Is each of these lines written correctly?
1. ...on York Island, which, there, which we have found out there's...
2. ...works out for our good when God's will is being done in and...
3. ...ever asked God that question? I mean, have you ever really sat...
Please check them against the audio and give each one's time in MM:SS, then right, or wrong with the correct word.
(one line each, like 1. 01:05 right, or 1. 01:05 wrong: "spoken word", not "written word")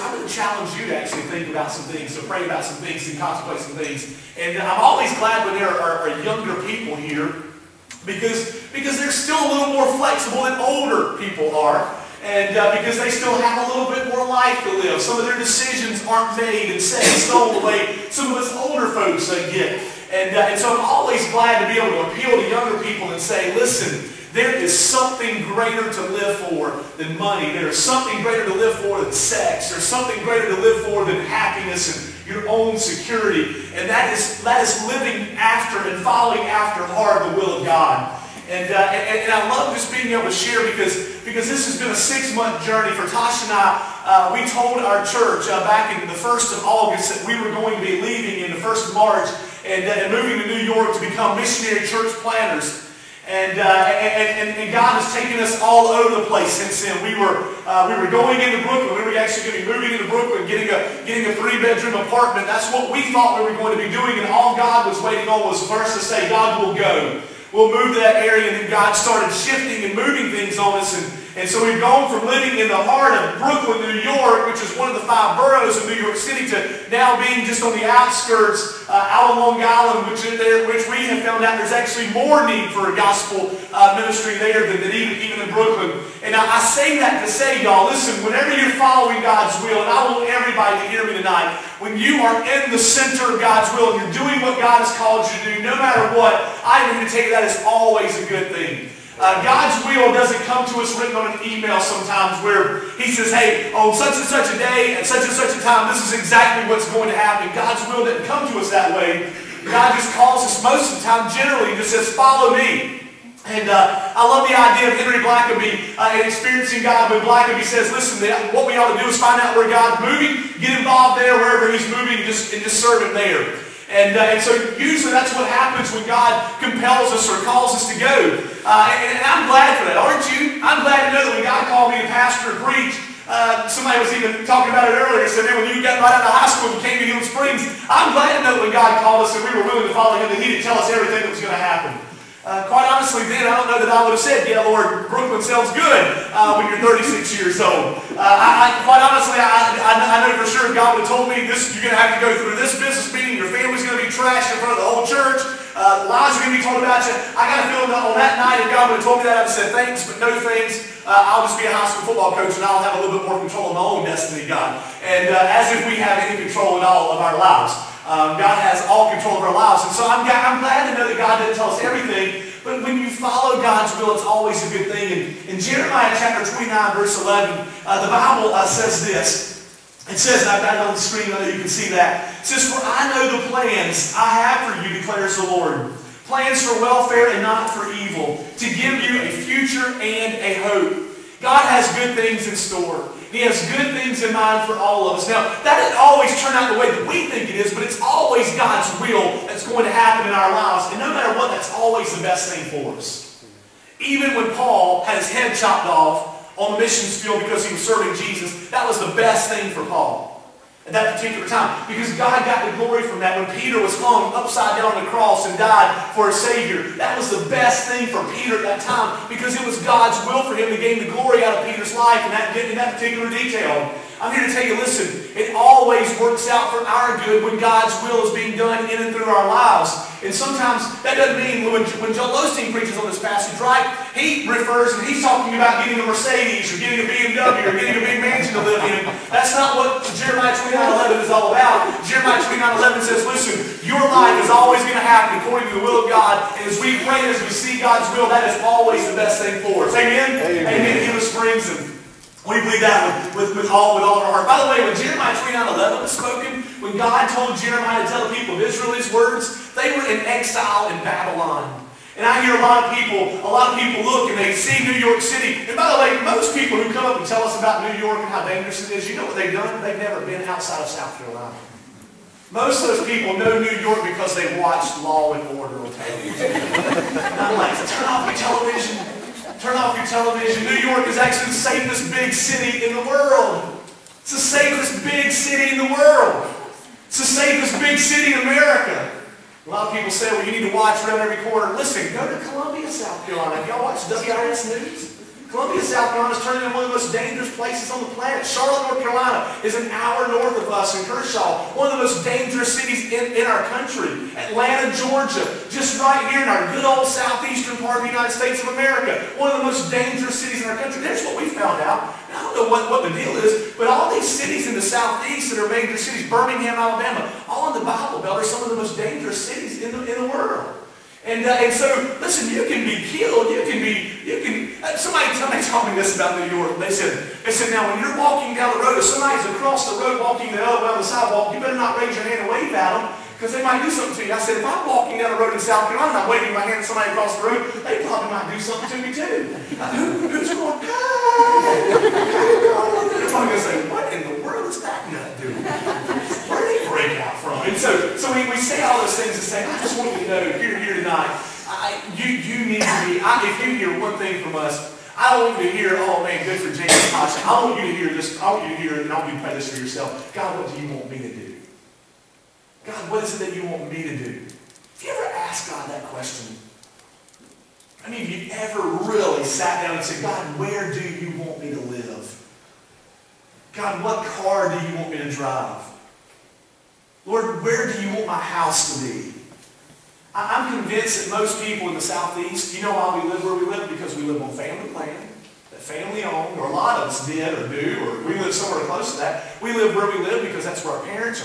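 1. 01:19 wrong: "Long", not "York"
2. 03:46 right
3. 06:05 right.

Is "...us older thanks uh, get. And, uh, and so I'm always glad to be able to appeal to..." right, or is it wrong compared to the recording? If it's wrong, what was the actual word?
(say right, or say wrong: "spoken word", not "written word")
wrong: "folks", not "thanks".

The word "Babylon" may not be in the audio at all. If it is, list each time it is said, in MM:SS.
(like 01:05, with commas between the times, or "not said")
04:21.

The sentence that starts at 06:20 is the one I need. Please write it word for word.
I'm convinced that most people in the Southeast, you know why we live where we live?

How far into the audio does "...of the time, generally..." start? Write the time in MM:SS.
01:50.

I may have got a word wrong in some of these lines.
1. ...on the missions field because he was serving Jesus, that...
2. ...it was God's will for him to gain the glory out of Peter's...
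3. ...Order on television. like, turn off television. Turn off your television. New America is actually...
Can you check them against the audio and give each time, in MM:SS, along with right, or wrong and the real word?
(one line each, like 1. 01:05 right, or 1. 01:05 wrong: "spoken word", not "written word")
1. 03:26 right
2. 03:39 right
3. 04:35 wrong: "York", not "America".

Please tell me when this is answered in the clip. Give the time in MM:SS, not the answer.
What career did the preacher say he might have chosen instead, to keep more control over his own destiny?
02:41.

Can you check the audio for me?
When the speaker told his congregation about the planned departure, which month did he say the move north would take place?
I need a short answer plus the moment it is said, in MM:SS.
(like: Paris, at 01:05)
March, at 00:48.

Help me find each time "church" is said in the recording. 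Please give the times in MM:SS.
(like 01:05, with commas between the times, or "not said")
00:45, 00:51, 02:35.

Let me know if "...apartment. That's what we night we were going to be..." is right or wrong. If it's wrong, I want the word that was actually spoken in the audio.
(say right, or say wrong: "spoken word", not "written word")
wrong: "thought", not "night".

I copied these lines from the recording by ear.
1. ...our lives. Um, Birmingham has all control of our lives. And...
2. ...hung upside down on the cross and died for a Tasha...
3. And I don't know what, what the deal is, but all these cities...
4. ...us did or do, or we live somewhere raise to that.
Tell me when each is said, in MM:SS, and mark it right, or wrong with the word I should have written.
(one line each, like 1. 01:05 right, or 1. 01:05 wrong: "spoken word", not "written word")
1. 02:47 wrong: "God", not "Birmingham"
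2. 03:34 wrong: "Savior", not "Tasha"
3. 05:12 right
4. 06:27 wrong: "close", not "raise".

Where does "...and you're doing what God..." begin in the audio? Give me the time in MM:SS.
01:33.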